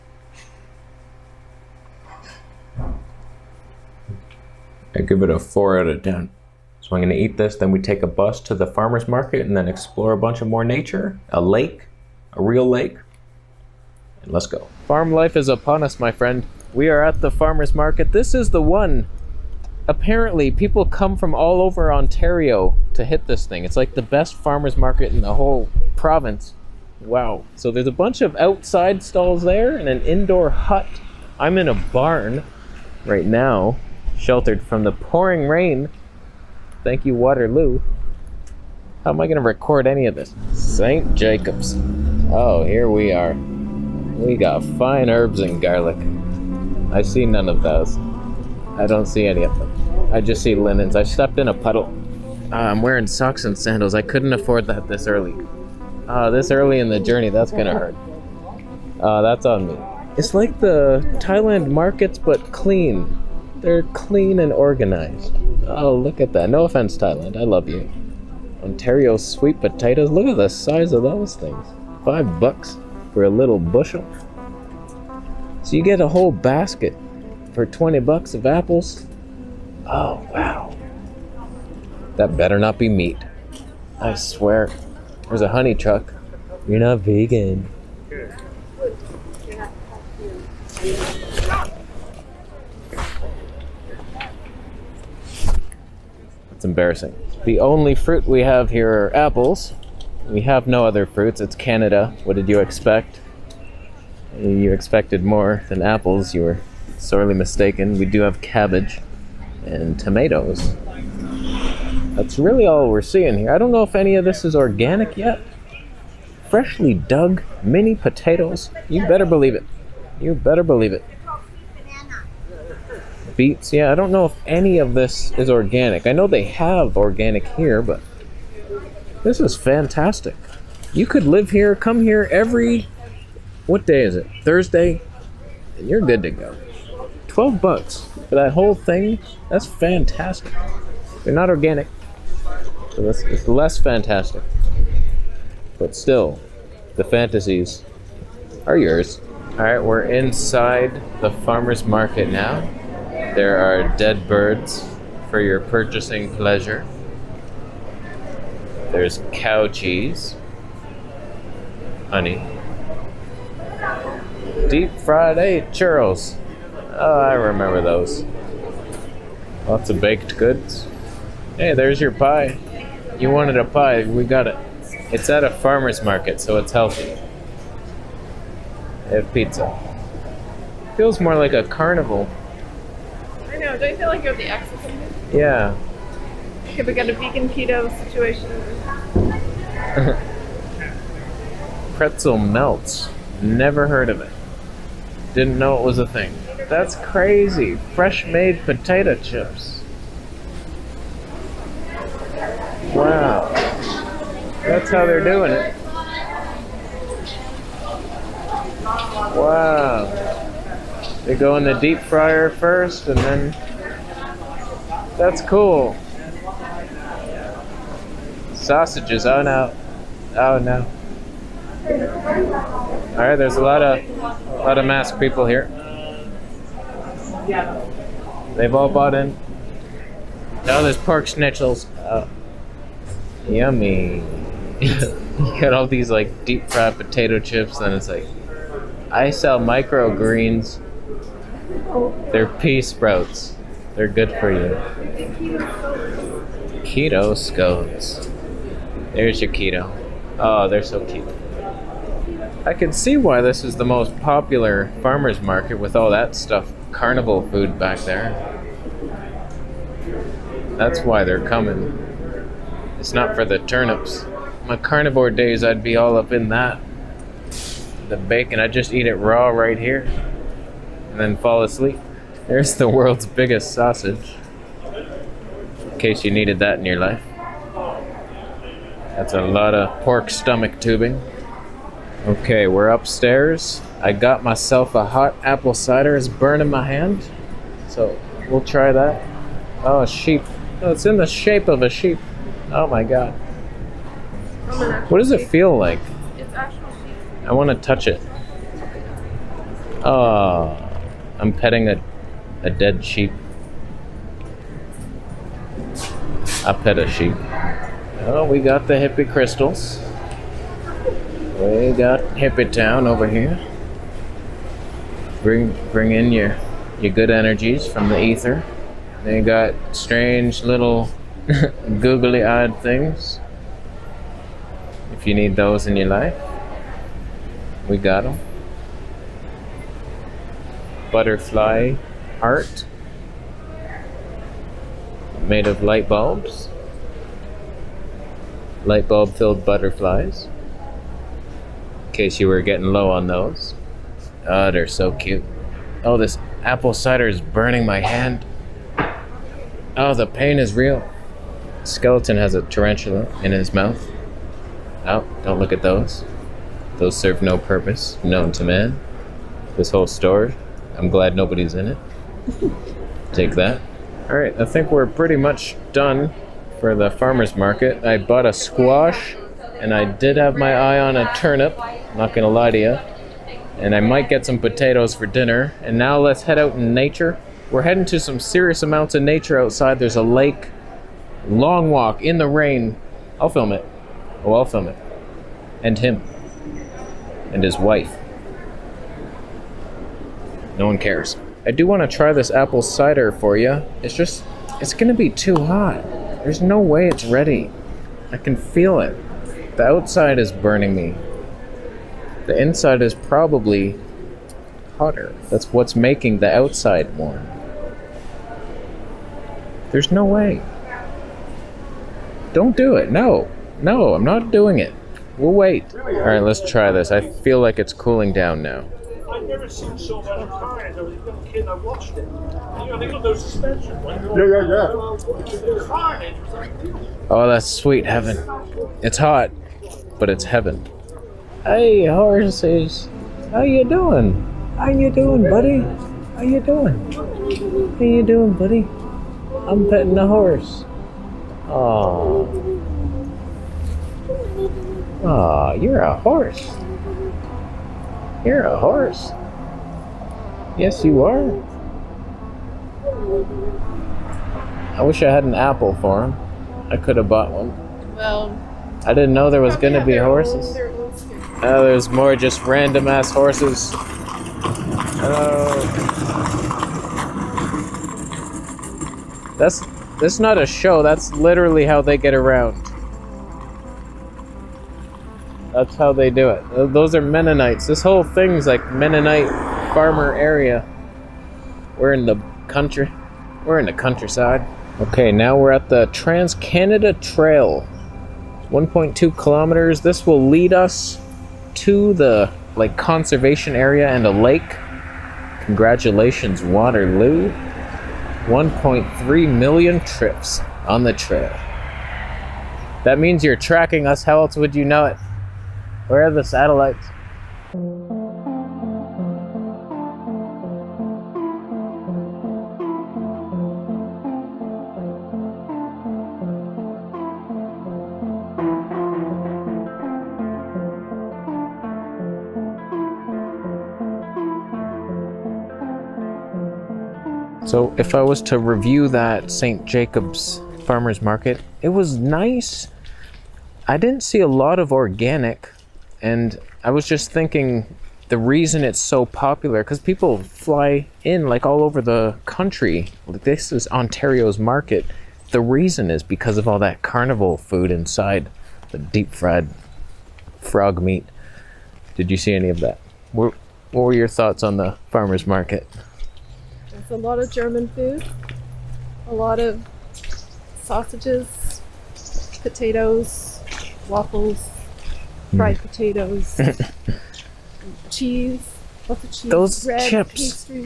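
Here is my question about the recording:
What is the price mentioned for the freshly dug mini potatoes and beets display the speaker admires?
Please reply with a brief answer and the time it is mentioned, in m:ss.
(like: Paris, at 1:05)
$12, at 2:17.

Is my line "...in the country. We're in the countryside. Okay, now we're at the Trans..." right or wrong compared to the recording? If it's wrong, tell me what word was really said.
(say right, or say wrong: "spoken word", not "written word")
right.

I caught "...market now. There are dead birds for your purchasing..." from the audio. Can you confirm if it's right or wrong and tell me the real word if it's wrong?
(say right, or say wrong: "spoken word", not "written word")
right.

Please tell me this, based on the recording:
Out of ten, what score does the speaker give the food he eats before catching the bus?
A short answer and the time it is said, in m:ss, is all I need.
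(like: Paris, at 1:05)
4, at 0:05.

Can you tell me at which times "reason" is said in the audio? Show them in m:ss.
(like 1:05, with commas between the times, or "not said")
8:58, 9:05.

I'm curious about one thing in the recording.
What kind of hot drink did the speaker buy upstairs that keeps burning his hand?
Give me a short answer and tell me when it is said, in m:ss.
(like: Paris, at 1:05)
Hot apple cider, at 4:45.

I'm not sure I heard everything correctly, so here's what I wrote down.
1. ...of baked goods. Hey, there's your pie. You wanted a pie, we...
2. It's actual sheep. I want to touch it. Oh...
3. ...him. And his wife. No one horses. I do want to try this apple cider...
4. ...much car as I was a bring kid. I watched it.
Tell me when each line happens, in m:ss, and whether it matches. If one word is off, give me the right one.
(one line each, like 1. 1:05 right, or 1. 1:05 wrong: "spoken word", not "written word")
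1. 2:49 right
2. 4:56 right
3. 6:25 wrong: "cares", not "horses"
4. 7:00 wrong: "young", not "bring".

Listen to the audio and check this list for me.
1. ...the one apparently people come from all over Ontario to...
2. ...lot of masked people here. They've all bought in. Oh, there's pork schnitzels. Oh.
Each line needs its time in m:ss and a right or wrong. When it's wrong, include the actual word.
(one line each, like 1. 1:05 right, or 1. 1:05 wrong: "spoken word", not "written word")
1. 0:18 right
2. 3:44 right.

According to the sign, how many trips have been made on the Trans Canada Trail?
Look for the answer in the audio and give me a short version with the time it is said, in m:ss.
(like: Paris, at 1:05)
1.3 million, at 8:18.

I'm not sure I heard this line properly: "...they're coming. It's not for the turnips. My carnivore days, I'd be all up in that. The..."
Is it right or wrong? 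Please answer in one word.
right.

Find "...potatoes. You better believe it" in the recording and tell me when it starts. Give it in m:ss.
1:57.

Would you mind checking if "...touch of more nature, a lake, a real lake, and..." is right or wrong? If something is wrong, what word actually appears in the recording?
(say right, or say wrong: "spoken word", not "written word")
wrong: "bunch", not "touch".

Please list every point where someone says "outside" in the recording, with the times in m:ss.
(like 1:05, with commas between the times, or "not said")
0:28, 6:19, 6:39, 6:46.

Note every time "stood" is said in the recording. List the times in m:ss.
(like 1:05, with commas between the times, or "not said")
not said.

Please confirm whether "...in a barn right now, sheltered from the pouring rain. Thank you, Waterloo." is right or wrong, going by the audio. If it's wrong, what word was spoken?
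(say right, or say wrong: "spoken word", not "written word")
right.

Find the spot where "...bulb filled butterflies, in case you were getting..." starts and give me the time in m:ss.
5:39.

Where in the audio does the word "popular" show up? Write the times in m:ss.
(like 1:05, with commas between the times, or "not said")
4:14, 8:59.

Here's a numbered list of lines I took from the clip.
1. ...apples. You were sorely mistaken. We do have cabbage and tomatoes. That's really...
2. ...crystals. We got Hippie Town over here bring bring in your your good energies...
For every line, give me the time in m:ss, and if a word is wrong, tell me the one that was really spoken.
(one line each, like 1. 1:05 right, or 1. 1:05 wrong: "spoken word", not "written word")
1. 1:45 right
2. 5:09 right.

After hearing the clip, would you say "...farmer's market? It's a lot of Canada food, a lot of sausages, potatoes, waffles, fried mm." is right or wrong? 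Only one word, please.
wrong.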